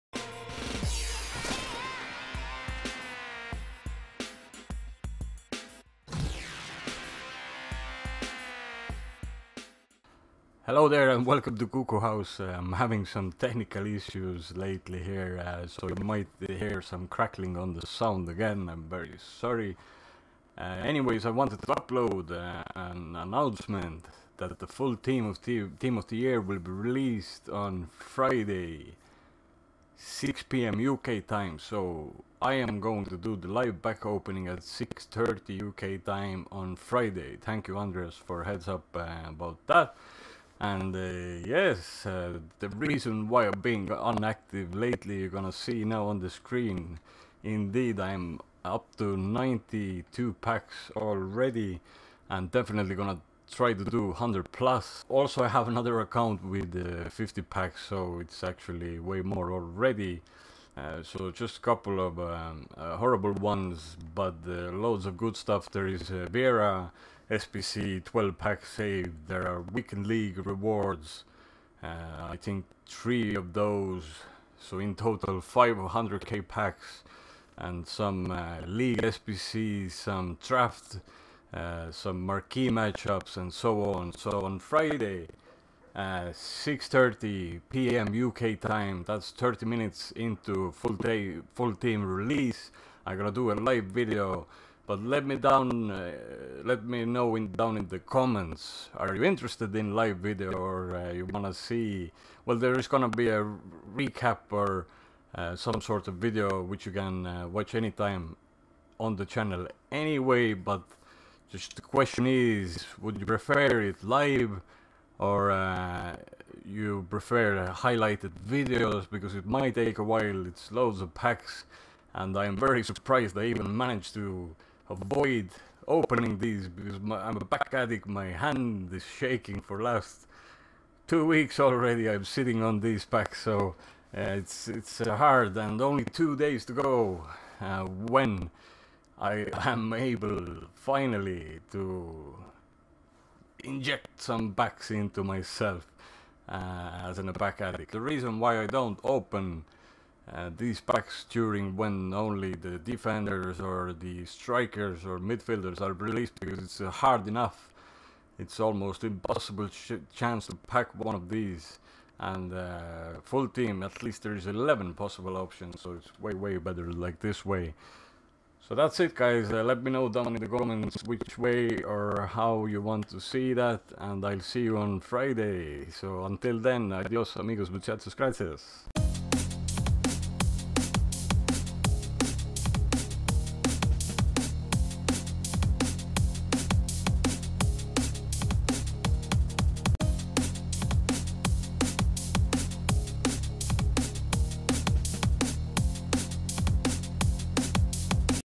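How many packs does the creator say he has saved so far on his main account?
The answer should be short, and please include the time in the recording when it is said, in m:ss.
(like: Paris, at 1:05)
92, at 0:49.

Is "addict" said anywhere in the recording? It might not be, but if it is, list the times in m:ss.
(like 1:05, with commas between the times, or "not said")
2:07, 2:27.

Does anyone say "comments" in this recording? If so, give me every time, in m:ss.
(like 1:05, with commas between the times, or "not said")
1:37, 2:50.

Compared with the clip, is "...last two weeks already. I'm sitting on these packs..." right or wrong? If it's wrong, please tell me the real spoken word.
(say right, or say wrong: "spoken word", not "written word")
right.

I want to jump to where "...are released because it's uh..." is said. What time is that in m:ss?
2:35.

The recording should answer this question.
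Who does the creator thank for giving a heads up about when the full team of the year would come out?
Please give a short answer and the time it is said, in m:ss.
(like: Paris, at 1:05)
Andreas, at 0:37.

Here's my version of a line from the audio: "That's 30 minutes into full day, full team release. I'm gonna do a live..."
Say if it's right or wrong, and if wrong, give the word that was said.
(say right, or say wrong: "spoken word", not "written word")
right.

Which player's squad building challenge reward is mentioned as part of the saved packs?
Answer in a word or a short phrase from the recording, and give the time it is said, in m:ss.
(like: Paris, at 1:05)
Vieira, at 1:06.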